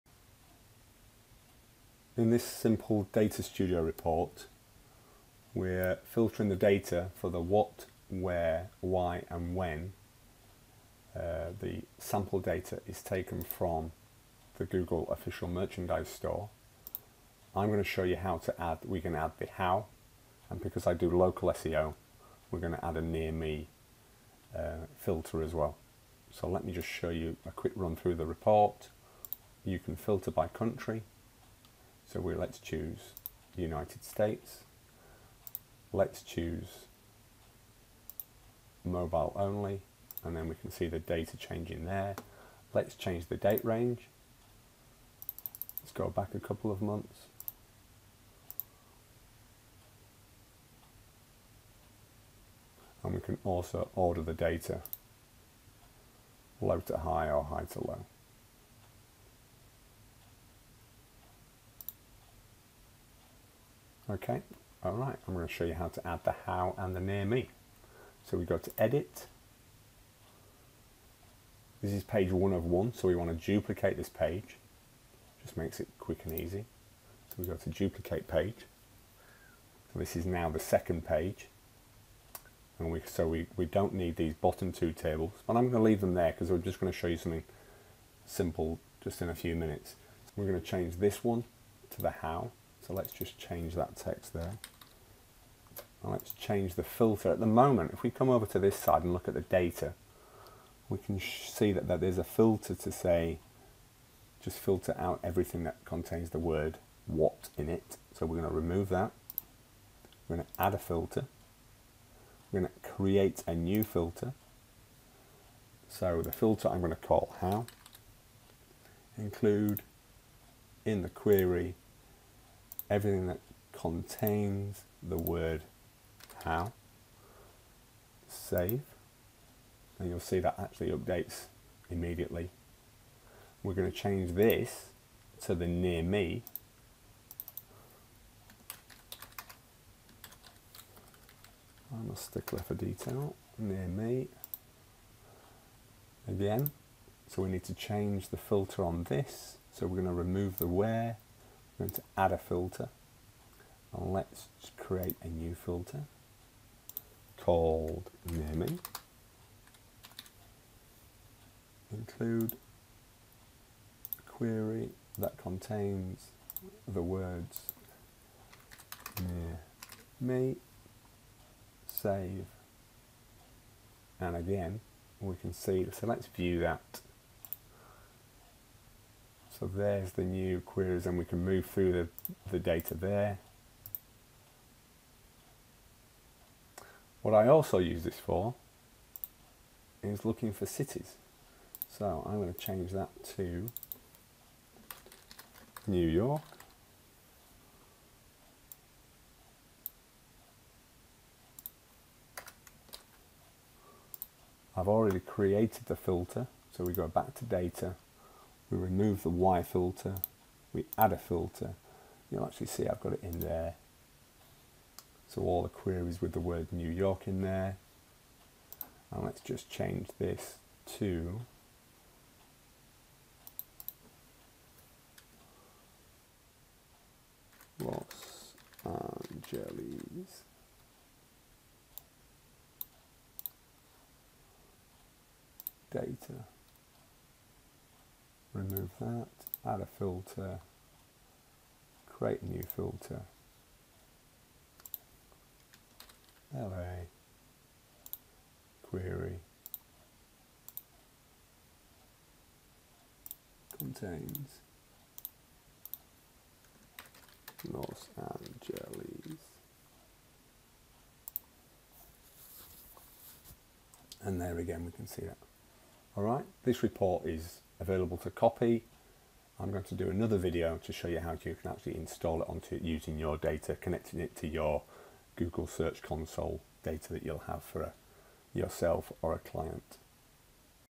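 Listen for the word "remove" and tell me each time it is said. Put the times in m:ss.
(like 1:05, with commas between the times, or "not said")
1:48, 2:30, 3:28, 3:58.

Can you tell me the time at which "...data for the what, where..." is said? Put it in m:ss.
0:06.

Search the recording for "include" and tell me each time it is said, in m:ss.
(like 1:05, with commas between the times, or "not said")
1:59, 2:41.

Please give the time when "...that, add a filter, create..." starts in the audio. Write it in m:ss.
3:58.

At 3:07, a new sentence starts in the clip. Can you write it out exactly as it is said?
What I also use this for is looking for cities.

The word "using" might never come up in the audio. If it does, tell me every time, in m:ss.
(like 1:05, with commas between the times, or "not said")
4:32.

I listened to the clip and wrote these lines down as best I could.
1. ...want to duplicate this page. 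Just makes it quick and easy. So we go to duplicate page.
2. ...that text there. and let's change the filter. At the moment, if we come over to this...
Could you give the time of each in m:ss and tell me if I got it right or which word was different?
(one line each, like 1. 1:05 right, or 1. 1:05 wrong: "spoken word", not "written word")
1. 1:13 right
2. 1:33 right.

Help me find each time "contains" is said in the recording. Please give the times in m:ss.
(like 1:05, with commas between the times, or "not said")
1:45, 2:03, 2:45, 4:13.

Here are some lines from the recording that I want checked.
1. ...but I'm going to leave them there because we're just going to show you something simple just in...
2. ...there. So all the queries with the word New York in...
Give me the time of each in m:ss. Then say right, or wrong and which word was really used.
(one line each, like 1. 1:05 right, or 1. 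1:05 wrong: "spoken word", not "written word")
1. 1:25 right
2. 3:33 right.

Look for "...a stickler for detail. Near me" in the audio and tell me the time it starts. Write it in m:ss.
2:22.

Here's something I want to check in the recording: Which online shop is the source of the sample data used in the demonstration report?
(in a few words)
Google official merchandise store.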